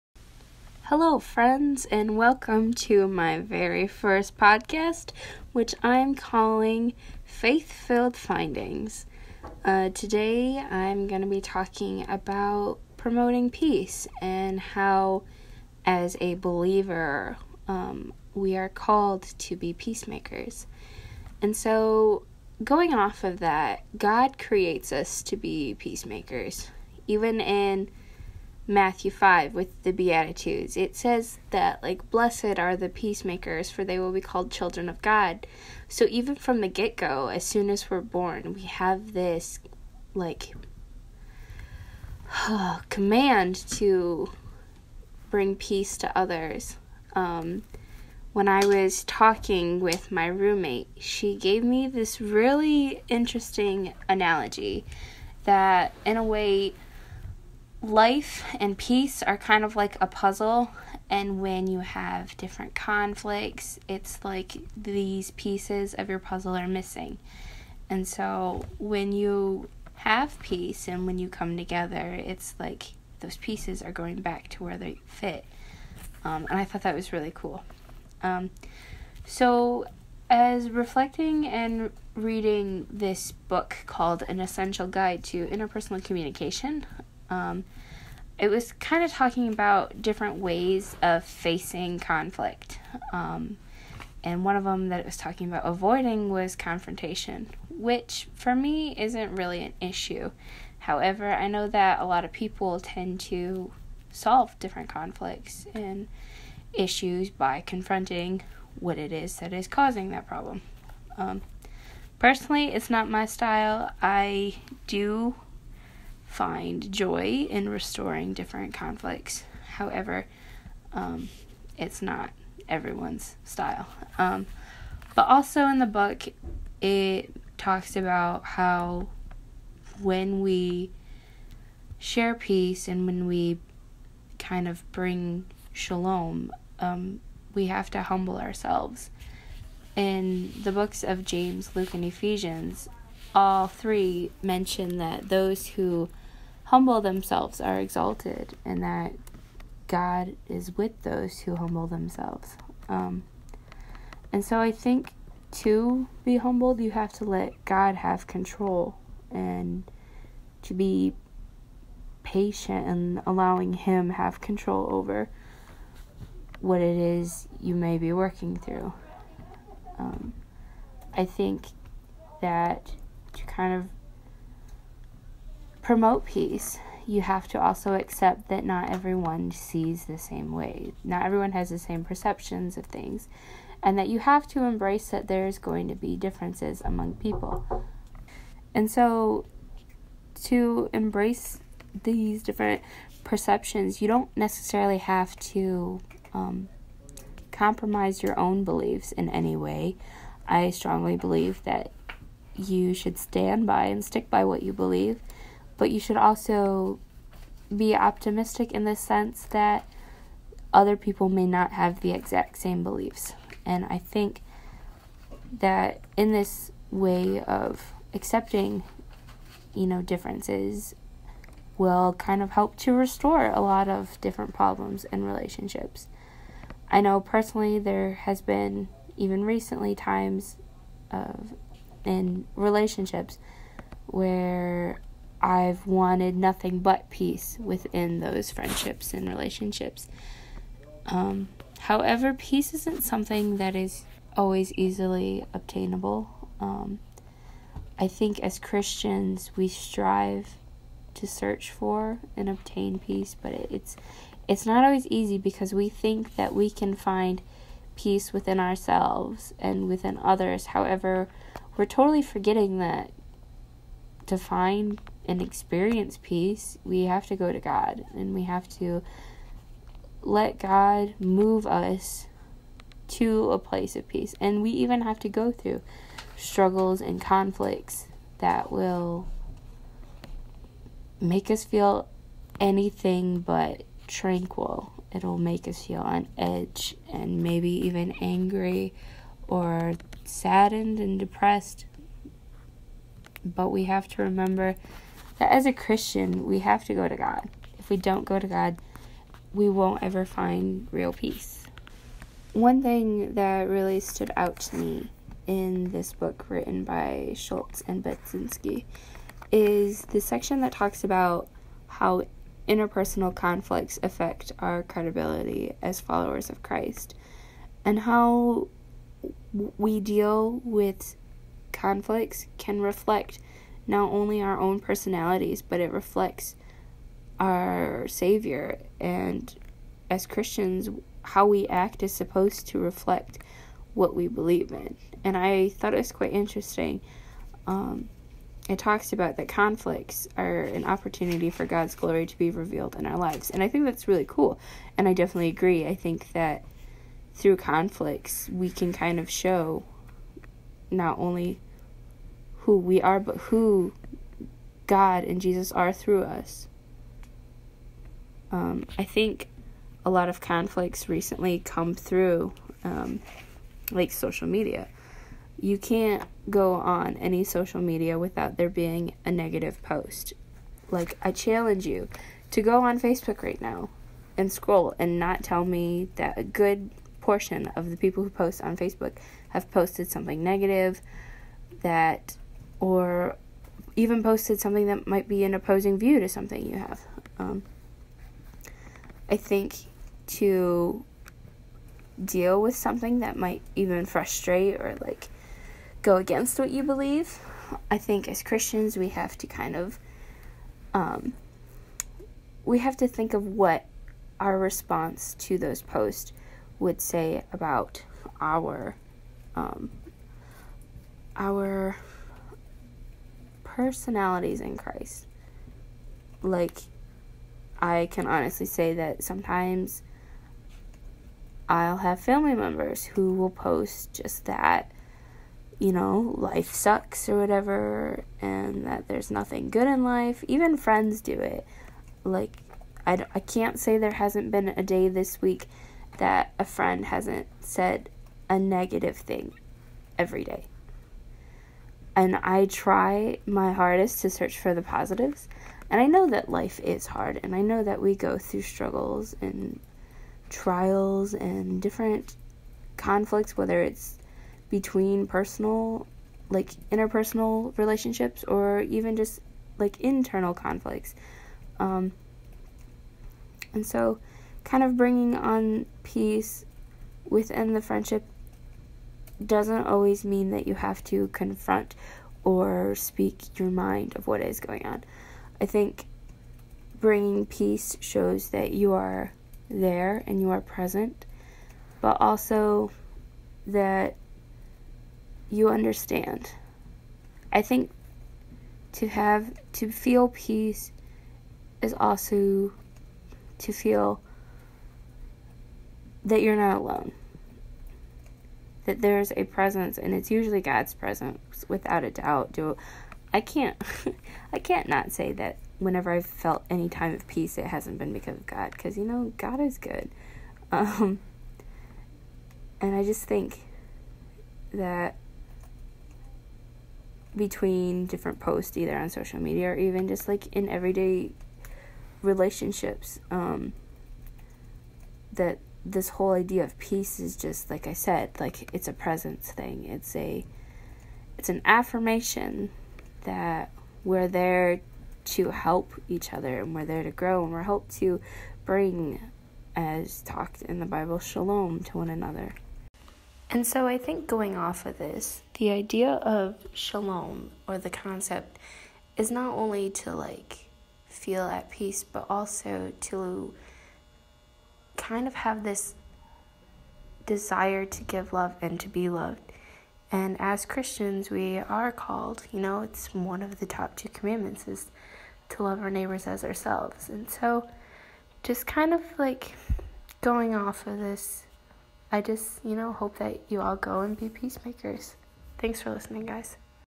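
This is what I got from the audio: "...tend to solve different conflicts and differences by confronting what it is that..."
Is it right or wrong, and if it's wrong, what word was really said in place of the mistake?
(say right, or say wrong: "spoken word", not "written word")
wrong: "issues", not "differences".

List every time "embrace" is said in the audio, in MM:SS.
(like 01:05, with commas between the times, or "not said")
03:04, 03:10.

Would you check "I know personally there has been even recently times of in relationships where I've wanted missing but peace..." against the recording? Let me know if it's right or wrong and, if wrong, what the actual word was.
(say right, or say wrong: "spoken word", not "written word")
wrong: "nothing", not "missing".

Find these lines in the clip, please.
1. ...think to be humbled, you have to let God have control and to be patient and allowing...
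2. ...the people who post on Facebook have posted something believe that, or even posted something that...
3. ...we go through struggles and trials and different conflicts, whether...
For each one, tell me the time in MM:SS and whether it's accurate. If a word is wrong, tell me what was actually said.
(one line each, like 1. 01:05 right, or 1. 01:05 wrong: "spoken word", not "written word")
1. 02:34 right
2. 06:17 wrong: "negative", not "believe"
3. 07:27 right.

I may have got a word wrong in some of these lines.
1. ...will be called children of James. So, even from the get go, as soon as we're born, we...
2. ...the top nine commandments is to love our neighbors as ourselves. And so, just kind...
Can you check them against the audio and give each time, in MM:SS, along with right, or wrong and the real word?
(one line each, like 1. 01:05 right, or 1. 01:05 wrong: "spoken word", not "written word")
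1. 00:33 wrong: "God", not "James"
2. 09:23 wrong: "two", not "nine".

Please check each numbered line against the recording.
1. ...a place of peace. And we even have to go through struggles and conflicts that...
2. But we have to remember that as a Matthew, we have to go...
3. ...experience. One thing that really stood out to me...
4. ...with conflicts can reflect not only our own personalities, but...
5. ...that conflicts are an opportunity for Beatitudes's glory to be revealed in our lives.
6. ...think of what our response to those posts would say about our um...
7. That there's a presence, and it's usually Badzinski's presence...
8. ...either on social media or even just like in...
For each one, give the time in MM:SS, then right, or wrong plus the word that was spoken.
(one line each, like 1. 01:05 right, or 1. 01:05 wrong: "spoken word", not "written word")
1. 04:33 right
2. 04:53 wrong: "Christian", not "Matthew"
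3. 05:01 wrong: "peace", not "experience"
4. 05:20 right
5. 05:39 wrong: "God", not "Beatitudes"
6. 06:43 right
7. 08:18 wrong: "God", not "Badzinski"
8. 08:38 right.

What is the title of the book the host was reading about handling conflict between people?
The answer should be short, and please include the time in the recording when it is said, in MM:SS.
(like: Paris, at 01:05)
An Essential Guide to Interpersonal Communication, at 01:24.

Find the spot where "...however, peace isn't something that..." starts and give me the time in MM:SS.
04:01.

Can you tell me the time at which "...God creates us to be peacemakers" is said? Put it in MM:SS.
00:23.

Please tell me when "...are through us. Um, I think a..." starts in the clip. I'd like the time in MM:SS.
05:55.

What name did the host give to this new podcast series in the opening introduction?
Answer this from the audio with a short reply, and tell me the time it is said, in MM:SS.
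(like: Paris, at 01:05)
Faith Filled Findings, at 00:07.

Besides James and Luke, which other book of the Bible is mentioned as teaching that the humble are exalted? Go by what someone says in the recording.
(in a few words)
Ephesians.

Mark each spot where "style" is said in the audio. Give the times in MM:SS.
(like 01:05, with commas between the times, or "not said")
01:53, 02:03.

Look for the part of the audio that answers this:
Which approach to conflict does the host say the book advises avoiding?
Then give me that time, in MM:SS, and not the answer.
01:36.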